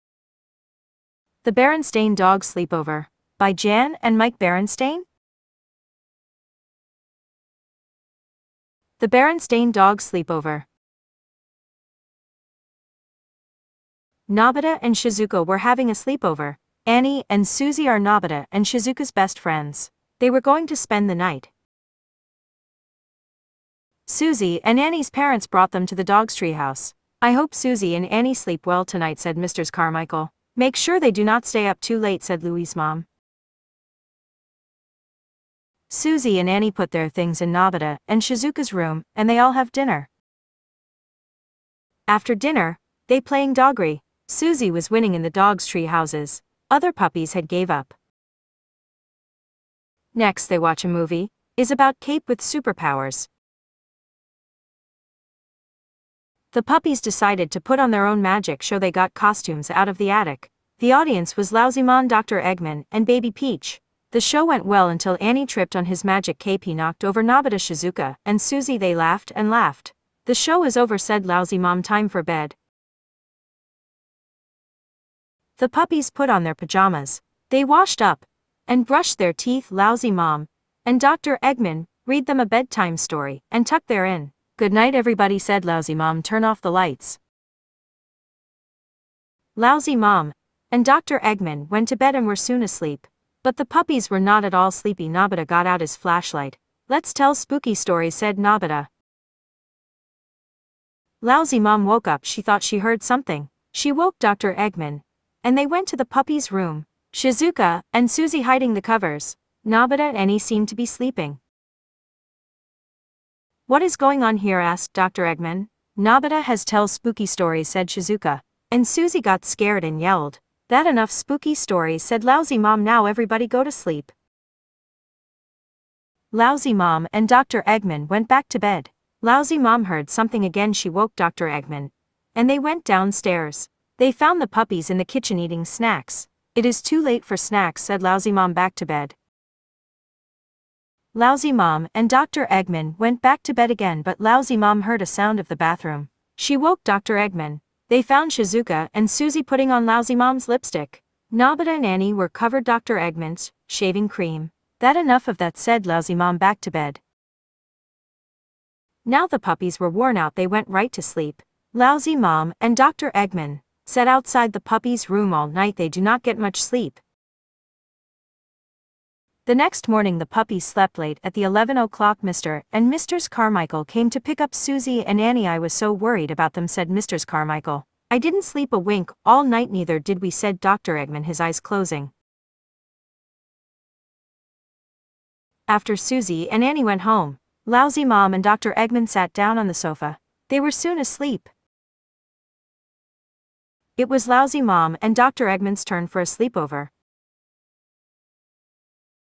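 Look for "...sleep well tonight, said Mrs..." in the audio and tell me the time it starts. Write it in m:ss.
0:28.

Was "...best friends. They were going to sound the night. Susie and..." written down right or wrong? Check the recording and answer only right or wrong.
wrong.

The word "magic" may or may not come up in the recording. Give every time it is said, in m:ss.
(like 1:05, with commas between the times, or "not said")
0:58, 1:06.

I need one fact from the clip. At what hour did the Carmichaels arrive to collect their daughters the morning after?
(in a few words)
11 o'clock.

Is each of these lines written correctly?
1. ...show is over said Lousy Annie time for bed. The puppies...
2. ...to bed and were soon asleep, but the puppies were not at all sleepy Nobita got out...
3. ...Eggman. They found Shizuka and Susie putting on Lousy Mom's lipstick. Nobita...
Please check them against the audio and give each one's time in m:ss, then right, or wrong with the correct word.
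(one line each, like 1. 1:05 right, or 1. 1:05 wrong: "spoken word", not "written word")
1. 1:10 wrong: "Mom", not "Annie"
2. 1:31 right
3. 2:27 right.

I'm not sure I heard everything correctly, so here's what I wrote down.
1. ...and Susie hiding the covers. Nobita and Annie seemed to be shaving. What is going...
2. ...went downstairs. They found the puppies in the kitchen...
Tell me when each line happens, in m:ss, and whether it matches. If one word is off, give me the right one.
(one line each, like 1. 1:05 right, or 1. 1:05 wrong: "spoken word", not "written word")
1. 1:47 wrong: "sleeping", not "shaving"
2. 2:12 right.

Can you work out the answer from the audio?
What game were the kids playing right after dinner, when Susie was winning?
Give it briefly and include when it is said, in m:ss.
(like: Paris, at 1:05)
Doggery, at 0:43.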